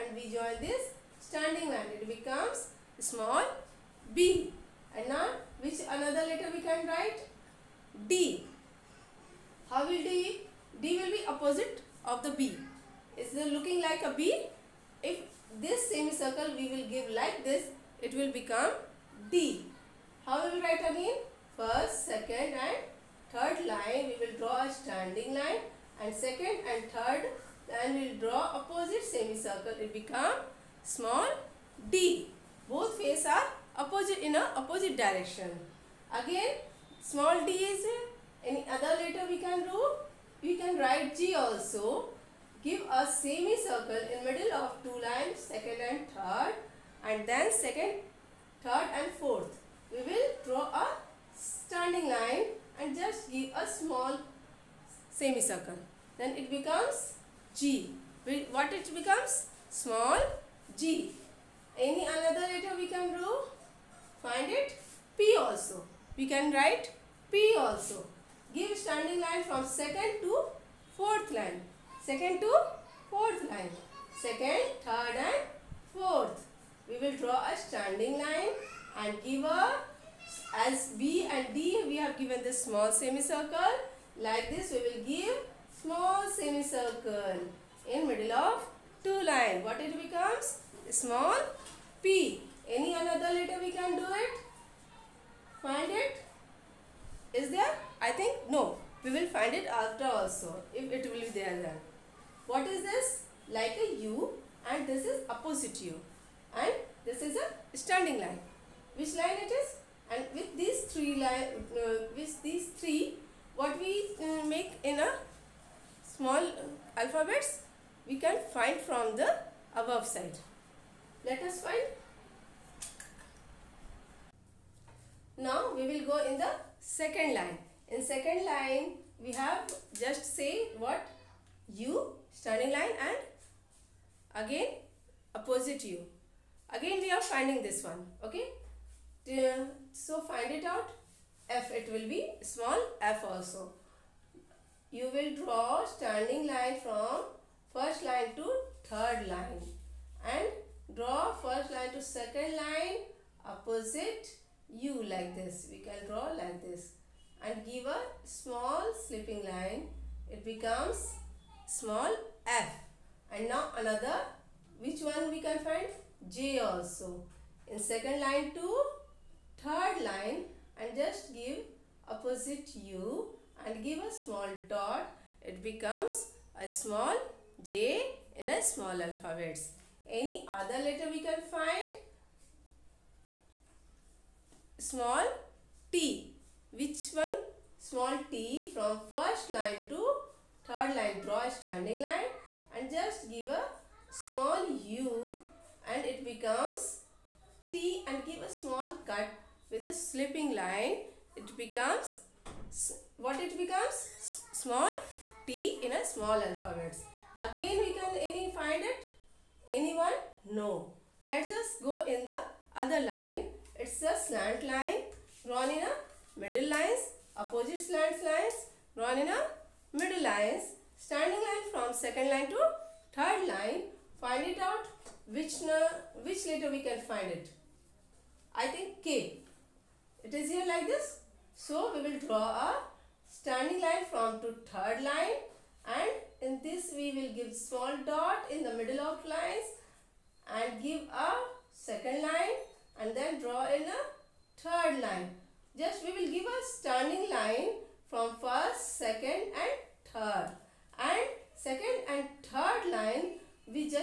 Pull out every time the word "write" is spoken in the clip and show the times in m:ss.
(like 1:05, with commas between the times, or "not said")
0:06, 0:20, 0:40, 1:06.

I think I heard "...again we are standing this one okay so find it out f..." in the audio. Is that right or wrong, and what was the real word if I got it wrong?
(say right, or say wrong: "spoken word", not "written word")
wrong: "finding", not "standing".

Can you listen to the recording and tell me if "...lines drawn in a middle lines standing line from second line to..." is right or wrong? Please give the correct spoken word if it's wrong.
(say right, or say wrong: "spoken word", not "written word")
right.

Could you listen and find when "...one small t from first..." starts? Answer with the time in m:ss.
3:07.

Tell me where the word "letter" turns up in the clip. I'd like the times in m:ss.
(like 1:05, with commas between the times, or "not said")
0:06, 0:39, 1:02, 1:33, 3:00, 3:46.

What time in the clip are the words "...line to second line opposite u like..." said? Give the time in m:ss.
2:31.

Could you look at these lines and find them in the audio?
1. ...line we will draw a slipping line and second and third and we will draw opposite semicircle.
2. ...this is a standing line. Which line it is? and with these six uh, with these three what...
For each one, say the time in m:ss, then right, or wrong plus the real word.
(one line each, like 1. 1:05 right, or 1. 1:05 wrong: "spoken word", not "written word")
1. 0:23 wrong: "standing", not "slipping"
2. 1:47 wrong: "three", not "six".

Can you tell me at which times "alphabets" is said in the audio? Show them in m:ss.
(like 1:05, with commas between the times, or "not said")
1:56, 2:59, 3:26.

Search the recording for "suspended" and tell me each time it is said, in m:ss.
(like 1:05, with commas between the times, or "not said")
not said.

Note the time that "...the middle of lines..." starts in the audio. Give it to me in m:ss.
3:58.